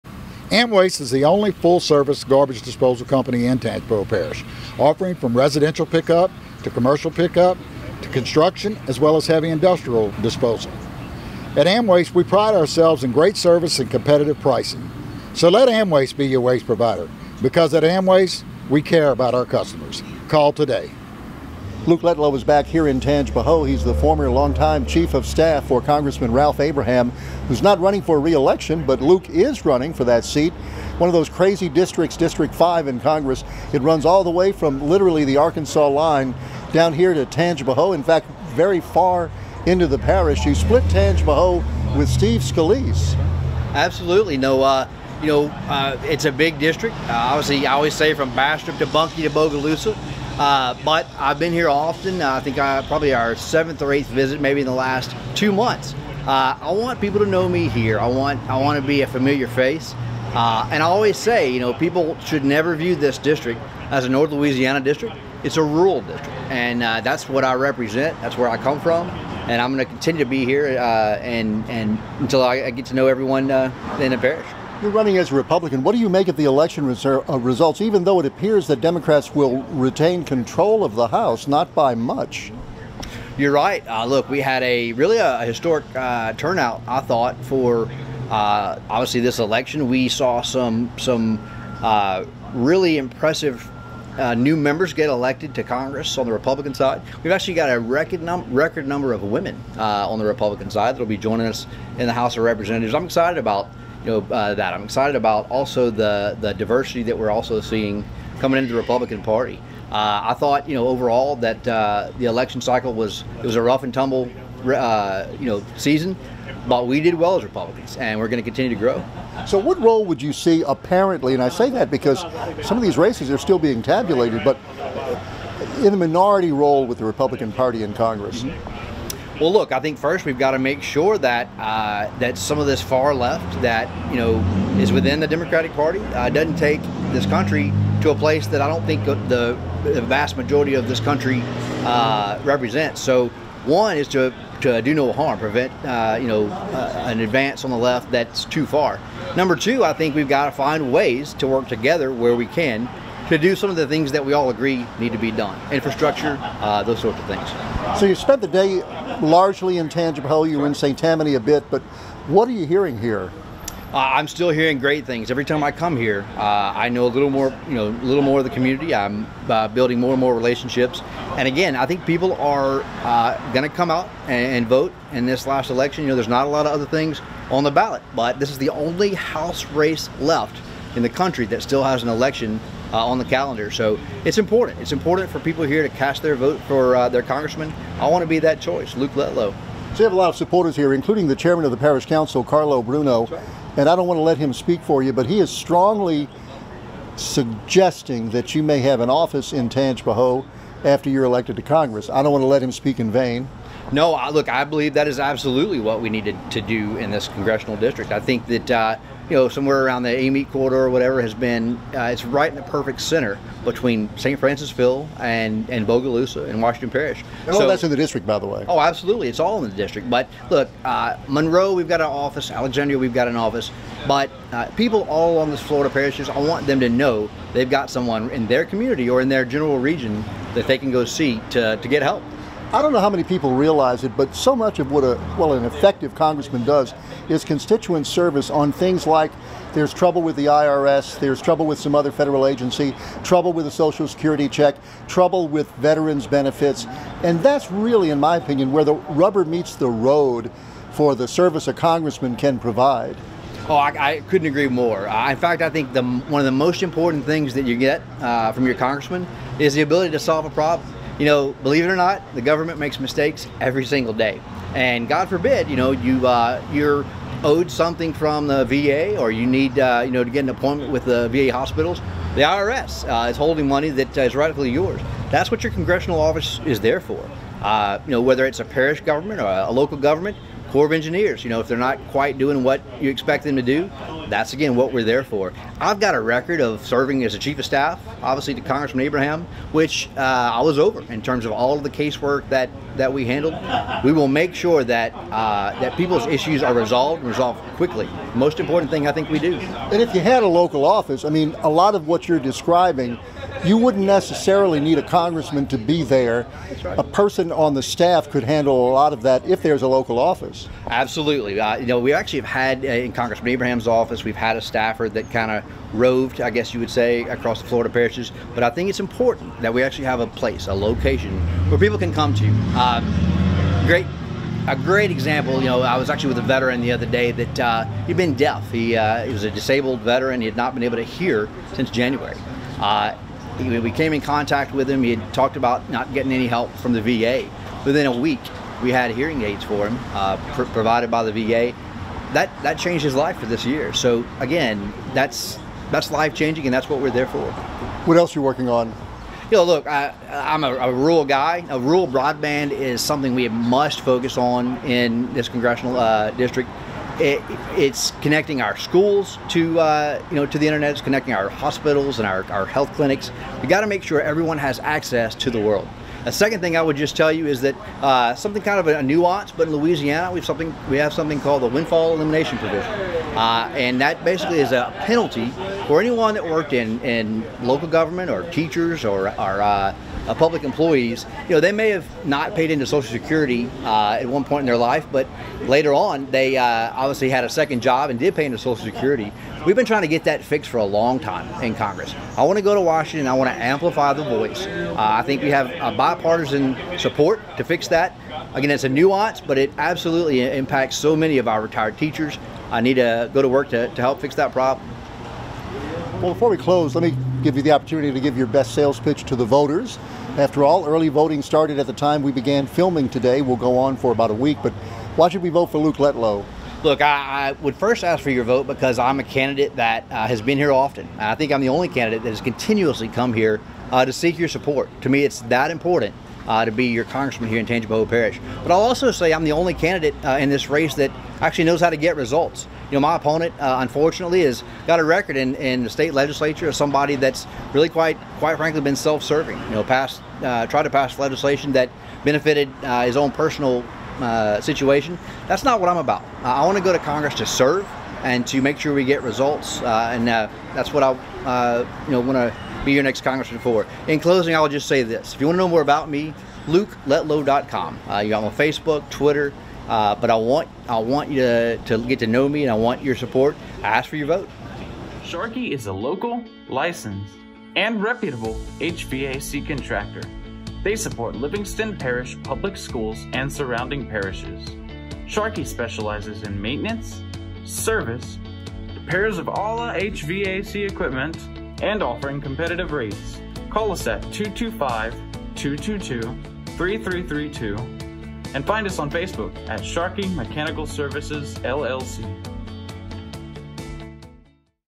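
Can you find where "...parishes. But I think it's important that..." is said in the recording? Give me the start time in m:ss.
5:17.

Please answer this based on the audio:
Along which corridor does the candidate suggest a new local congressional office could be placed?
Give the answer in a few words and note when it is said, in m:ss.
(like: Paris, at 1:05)
Amite corridor, at 3:30.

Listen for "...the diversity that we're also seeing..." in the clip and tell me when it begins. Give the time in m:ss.
1:46.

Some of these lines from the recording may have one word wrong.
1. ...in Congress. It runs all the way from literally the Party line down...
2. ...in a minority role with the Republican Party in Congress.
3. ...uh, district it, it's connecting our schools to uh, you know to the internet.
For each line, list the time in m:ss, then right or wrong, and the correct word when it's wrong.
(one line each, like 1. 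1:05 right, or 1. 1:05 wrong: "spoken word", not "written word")
1. 0:32 wrong: "Arkansas", not "Party"
2. 2:05 right
3. 5:55 right.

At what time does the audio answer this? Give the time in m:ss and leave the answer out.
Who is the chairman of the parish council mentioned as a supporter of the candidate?
3:12.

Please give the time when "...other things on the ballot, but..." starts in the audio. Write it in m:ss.
2:56.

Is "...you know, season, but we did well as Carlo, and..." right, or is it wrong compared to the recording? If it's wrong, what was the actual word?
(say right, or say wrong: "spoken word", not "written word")
wrong: "Republicans", not "Carlo".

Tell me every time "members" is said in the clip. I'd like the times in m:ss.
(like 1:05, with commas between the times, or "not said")
1:34.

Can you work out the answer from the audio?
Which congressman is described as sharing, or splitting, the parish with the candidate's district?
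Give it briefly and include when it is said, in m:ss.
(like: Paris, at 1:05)
Steve Scalise, at 0:42.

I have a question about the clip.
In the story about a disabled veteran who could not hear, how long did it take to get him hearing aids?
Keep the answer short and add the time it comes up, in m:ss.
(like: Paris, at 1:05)
Within a week, at 5:37.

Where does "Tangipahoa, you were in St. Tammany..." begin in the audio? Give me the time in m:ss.
2:40.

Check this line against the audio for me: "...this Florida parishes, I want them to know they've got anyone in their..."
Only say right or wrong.
wrong.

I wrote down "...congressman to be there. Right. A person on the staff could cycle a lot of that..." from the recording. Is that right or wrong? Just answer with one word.
wrong.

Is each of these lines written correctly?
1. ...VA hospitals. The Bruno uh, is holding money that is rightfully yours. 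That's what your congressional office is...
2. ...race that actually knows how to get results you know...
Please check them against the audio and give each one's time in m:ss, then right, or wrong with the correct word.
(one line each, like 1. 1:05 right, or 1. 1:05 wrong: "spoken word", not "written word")
1. 4:31 wrong: "IRS", not "Bruno"
2. 7:10 right.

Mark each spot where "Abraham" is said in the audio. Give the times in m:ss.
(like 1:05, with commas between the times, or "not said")
0:26, 4:49, 5:13.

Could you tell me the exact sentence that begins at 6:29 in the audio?
We've been trying to get that fixed for a long time in Congress.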